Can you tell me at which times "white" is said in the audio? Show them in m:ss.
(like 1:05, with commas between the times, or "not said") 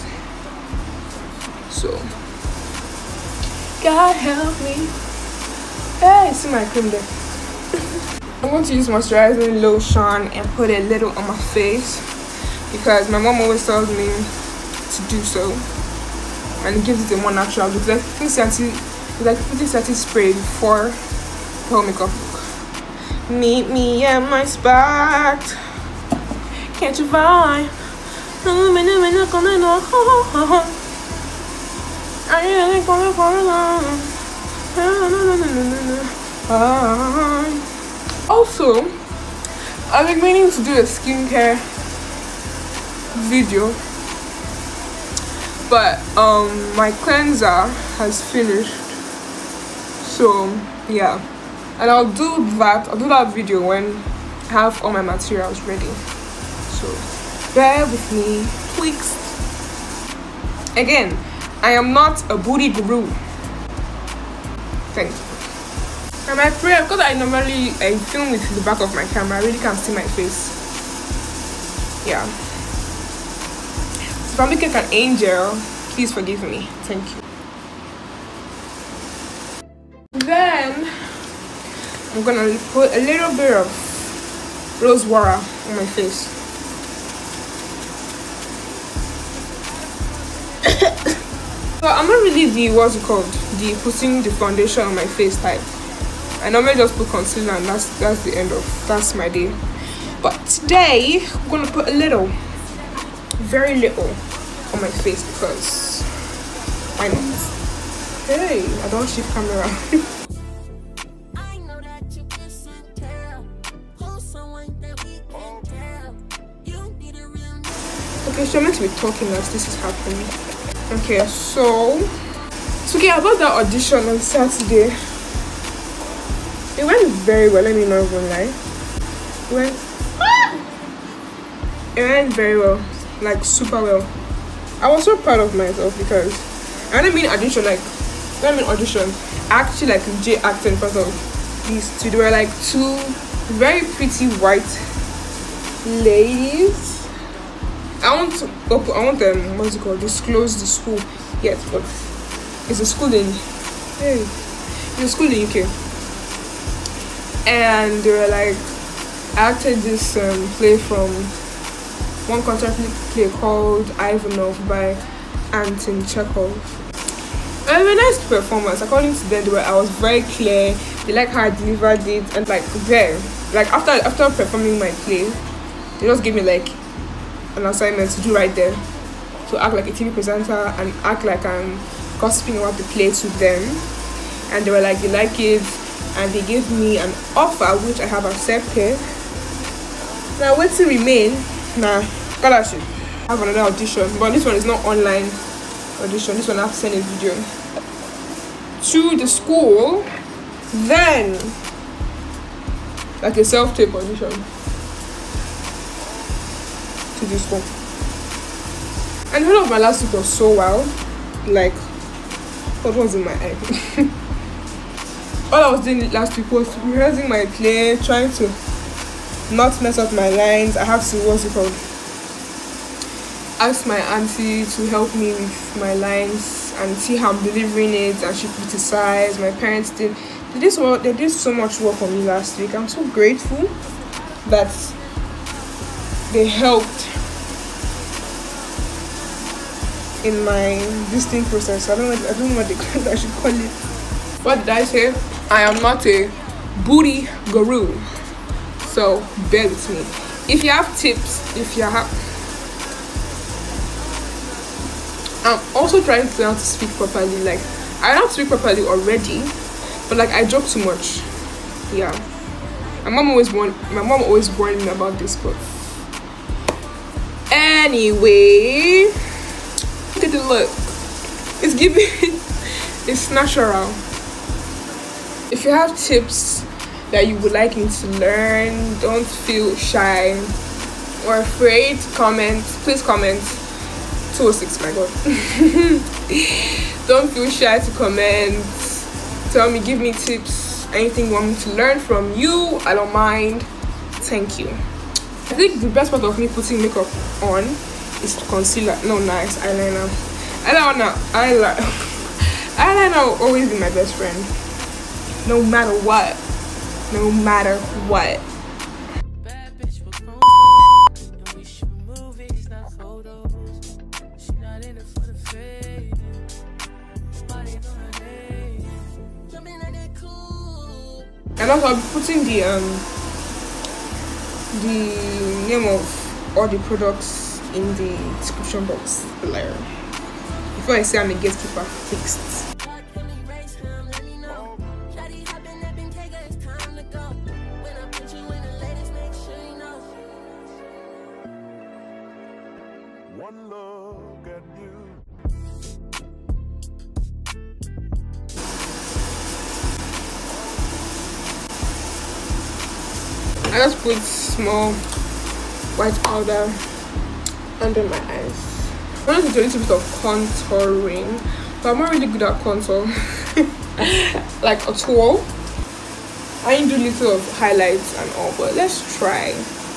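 2:24, 5:55.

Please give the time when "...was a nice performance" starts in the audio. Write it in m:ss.
2:47.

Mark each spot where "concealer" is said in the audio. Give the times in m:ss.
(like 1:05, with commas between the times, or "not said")
1:37, 4:58.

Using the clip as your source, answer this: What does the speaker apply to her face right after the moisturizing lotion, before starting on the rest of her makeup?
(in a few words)
rose water.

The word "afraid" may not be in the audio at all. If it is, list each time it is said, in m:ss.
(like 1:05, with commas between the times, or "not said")
4:41.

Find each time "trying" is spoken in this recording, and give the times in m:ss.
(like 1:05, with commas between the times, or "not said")
3:37, 4:16.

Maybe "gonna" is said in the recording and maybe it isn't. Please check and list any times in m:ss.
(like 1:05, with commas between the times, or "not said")
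1:22, 1:41.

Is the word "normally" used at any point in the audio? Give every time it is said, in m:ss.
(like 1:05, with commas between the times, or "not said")
1:07, 1:36.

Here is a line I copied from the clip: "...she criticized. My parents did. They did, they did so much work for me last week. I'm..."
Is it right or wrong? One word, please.
right.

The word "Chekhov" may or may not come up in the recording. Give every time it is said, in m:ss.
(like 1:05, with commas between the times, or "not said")
2:46.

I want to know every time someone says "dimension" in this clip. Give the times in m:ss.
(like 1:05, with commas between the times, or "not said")
not said.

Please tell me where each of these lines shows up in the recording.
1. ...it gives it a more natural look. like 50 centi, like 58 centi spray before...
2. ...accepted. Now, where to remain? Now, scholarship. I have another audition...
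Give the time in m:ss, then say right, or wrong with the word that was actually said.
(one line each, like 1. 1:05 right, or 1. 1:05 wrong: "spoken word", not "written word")
1. 0:16 wrong: "50", not "58"
2. 3:08 right.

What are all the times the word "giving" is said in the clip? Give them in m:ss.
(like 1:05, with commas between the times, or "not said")
4:31.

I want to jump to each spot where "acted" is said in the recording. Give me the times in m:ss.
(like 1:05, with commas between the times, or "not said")
2:20, 2:39.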